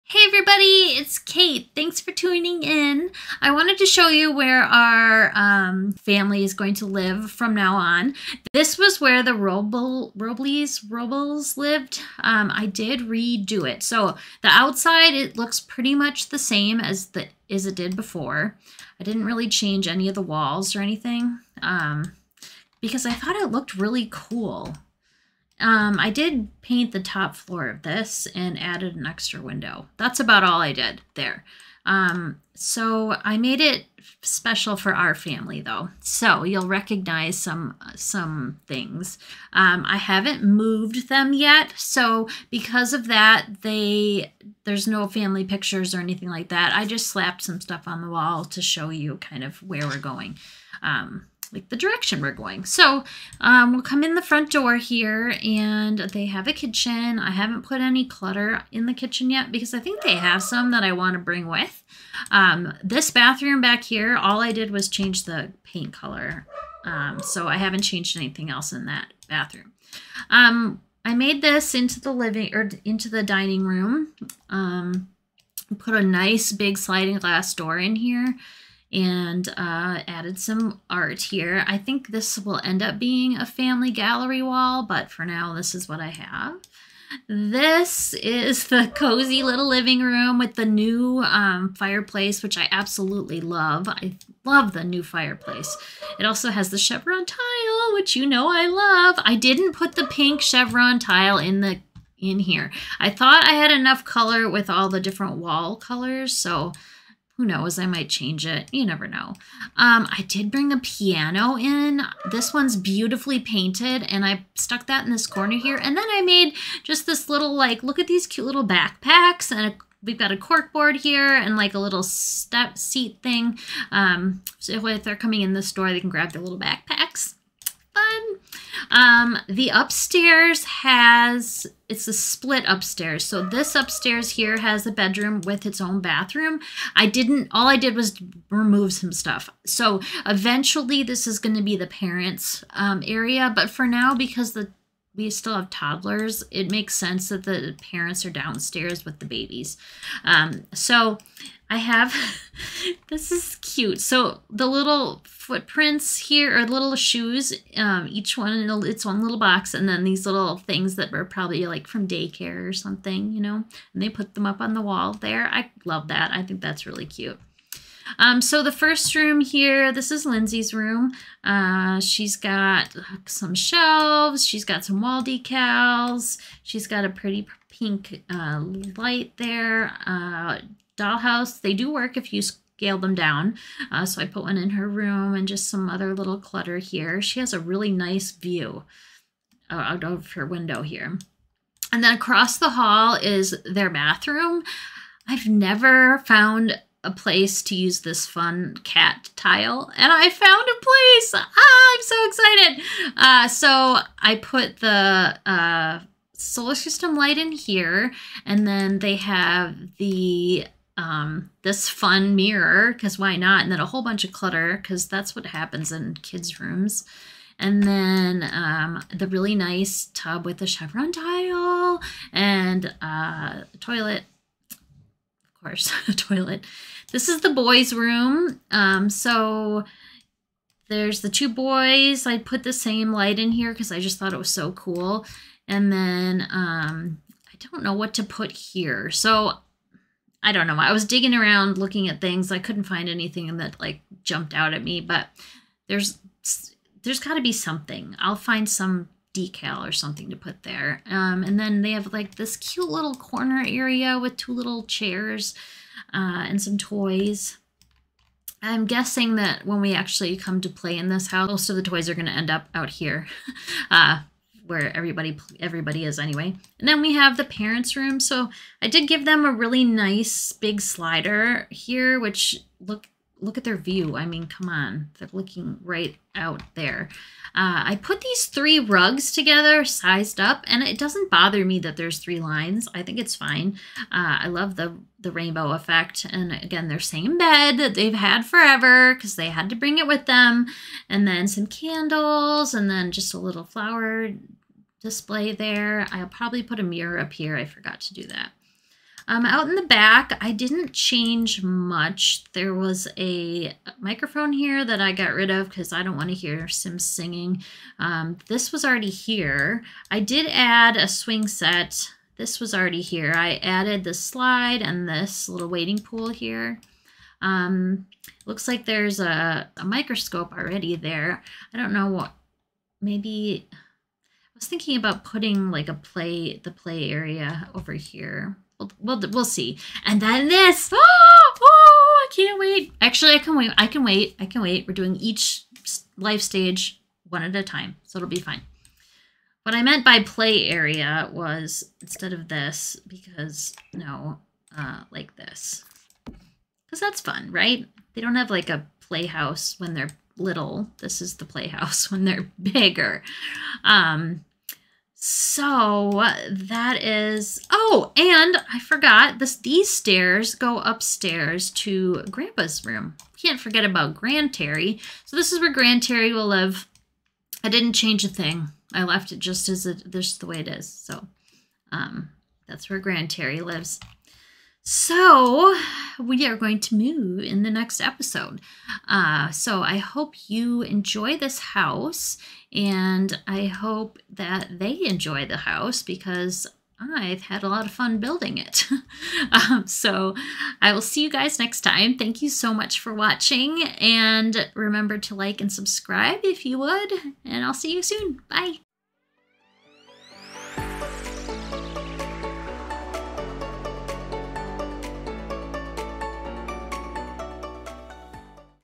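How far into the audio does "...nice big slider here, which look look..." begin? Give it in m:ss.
4:29.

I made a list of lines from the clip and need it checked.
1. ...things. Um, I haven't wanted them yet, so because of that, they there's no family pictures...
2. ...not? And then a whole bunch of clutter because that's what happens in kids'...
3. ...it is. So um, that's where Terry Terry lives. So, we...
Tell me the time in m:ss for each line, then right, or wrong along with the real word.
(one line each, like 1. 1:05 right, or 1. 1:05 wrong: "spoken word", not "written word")
1. 0:38 wrong: "moved", not "wanted"
2. 3:33 right
3. 6:10 wrong: "Grand", not "Terry".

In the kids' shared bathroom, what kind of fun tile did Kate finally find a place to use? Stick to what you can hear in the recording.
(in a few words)
Cat tile.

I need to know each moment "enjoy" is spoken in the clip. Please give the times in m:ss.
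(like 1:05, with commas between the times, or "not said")
6:20, 6:25.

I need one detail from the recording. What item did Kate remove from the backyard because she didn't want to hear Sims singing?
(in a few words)
A microphone.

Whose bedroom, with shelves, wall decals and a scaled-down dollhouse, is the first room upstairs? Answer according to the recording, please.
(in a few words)
Lindsay.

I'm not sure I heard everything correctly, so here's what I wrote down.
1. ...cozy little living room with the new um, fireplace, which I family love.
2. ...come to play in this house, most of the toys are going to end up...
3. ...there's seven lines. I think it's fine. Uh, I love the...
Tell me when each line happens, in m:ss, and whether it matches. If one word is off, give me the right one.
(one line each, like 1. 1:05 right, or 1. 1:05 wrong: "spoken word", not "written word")
1. 1:28 wrong: "absolutely", not "family"
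2. 4:20 right
3. 4:41 wrong: "three", not "seven".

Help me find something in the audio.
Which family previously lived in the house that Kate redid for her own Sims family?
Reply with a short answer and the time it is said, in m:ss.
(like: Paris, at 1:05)
Robles, at 0:10.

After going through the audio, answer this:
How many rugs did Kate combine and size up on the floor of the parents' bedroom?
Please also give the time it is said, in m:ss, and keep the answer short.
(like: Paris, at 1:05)
3, at 4:38.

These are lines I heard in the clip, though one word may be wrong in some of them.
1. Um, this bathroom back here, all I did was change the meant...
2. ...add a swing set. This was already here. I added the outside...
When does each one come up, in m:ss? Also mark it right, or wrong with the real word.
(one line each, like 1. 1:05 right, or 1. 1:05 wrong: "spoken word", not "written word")
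1. 1:02 wrong: "paint", not "meant"
2. 5:10 wrong: "slide", not "outside".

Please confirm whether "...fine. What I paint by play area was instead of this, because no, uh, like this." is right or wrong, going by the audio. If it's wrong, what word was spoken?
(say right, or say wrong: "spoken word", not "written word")
wrong: "meant", not "paint".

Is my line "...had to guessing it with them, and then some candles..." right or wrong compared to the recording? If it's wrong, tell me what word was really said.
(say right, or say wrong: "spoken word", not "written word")
wrong: "bring", not "guessing".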